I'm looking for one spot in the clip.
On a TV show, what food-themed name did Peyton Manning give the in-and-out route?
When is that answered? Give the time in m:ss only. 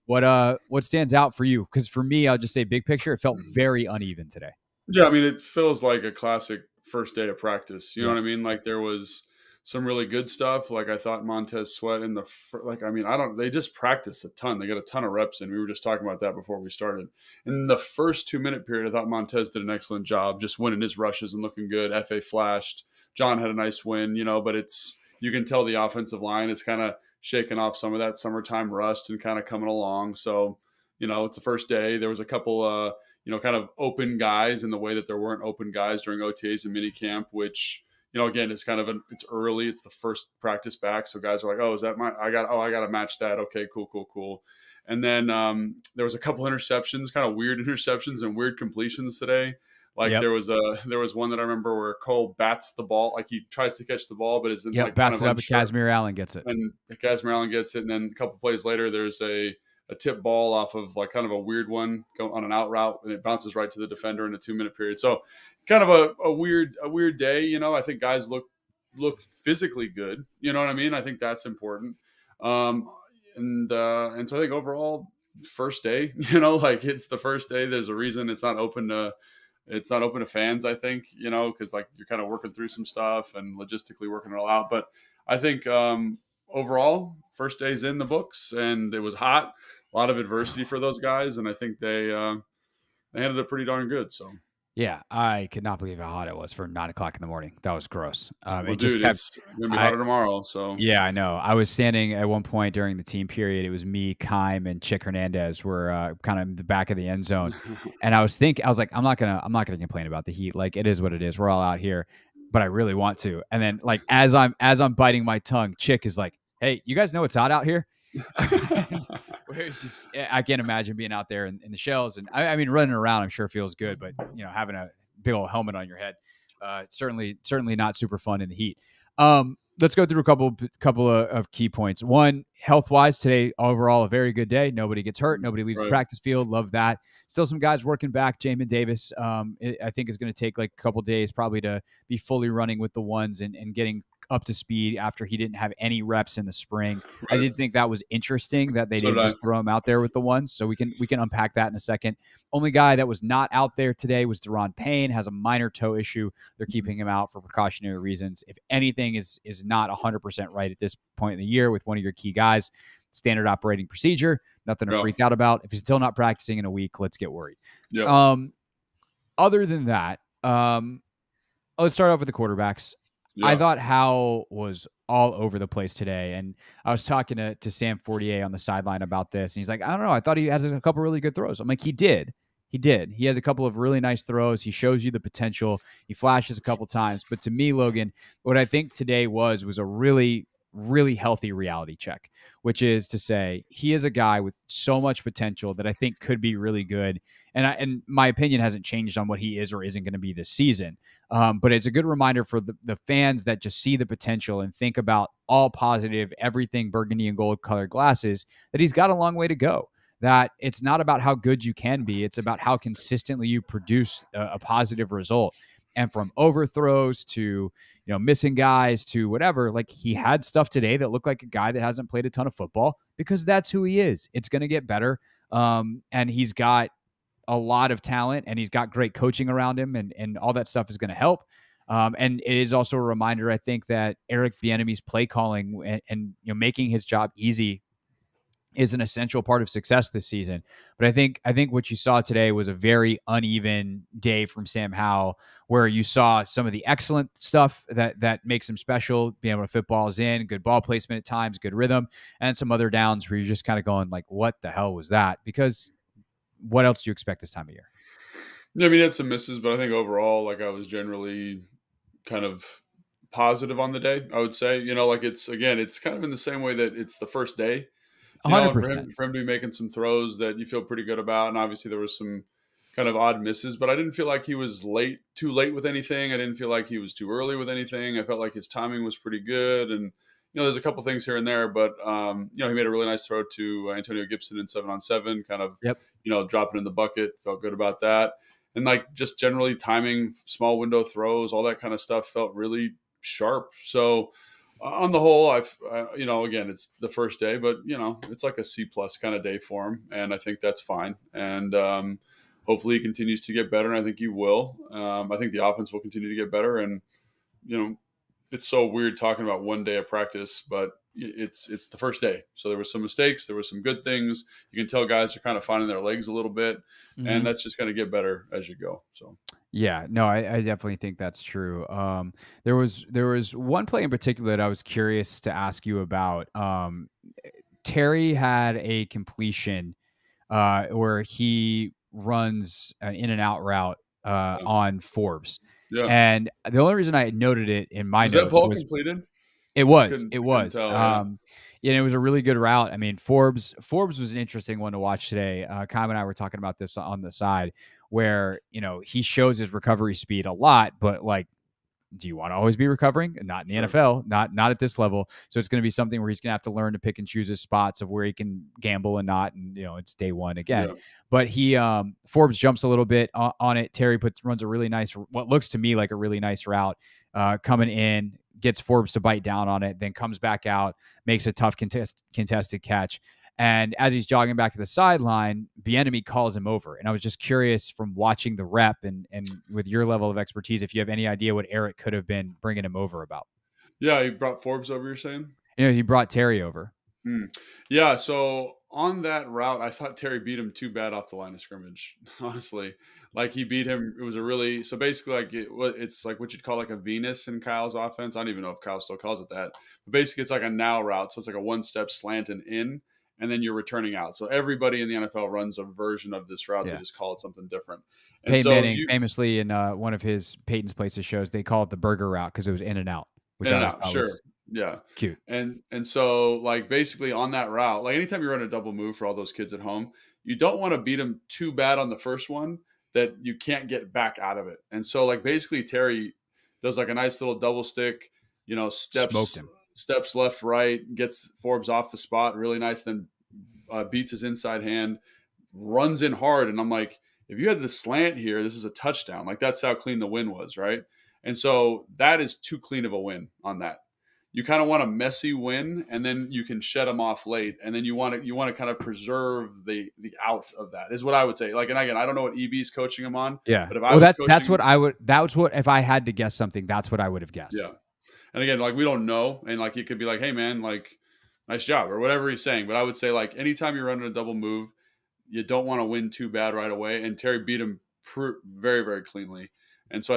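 6:51.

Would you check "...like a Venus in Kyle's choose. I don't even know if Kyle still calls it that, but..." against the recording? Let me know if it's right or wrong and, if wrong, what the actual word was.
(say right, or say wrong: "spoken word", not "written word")
wrong: "offense", not "choose".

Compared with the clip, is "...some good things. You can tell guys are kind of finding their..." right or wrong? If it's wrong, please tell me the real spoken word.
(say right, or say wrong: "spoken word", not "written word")
right.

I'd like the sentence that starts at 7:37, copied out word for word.
Yeah, and again, like we don't know, and like it could be like, hey man, like nice job or whatever he's saying.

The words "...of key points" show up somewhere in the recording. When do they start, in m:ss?
2:11.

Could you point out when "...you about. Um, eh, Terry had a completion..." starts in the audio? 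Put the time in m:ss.
5:25.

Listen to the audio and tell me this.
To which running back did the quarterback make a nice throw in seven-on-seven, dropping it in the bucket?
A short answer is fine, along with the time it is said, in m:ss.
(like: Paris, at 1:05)
Antonio Gibson, at 4:43.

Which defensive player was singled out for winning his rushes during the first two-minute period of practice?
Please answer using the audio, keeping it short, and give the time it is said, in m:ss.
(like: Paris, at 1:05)
Montez Sweat, at 0:11.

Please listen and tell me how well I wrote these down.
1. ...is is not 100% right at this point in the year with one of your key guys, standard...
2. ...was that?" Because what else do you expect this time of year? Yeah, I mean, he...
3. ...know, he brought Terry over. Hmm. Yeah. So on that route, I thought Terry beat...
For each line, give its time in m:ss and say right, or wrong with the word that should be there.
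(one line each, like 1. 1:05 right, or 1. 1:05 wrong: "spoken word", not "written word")
1. 2:39 right
2. 4:14 right
3. 6:25 right.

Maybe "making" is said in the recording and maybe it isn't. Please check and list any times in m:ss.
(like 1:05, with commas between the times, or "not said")
3:56, 4:29.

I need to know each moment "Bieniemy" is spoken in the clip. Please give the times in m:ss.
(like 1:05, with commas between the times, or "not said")
3:54, 6:15.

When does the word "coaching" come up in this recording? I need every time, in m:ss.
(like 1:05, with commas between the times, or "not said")
3:49, 7:32.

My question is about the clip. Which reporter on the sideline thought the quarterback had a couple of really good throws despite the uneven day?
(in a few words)
Sam Fortier.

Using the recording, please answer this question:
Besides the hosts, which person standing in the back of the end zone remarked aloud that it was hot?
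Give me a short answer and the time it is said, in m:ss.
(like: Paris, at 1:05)
Chick Hernandez, at 1:44.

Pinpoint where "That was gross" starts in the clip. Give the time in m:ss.
1:37.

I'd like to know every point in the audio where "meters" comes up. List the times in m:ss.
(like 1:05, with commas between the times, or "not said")
not said.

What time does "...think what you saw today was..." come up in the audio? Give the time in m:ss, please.
4:01.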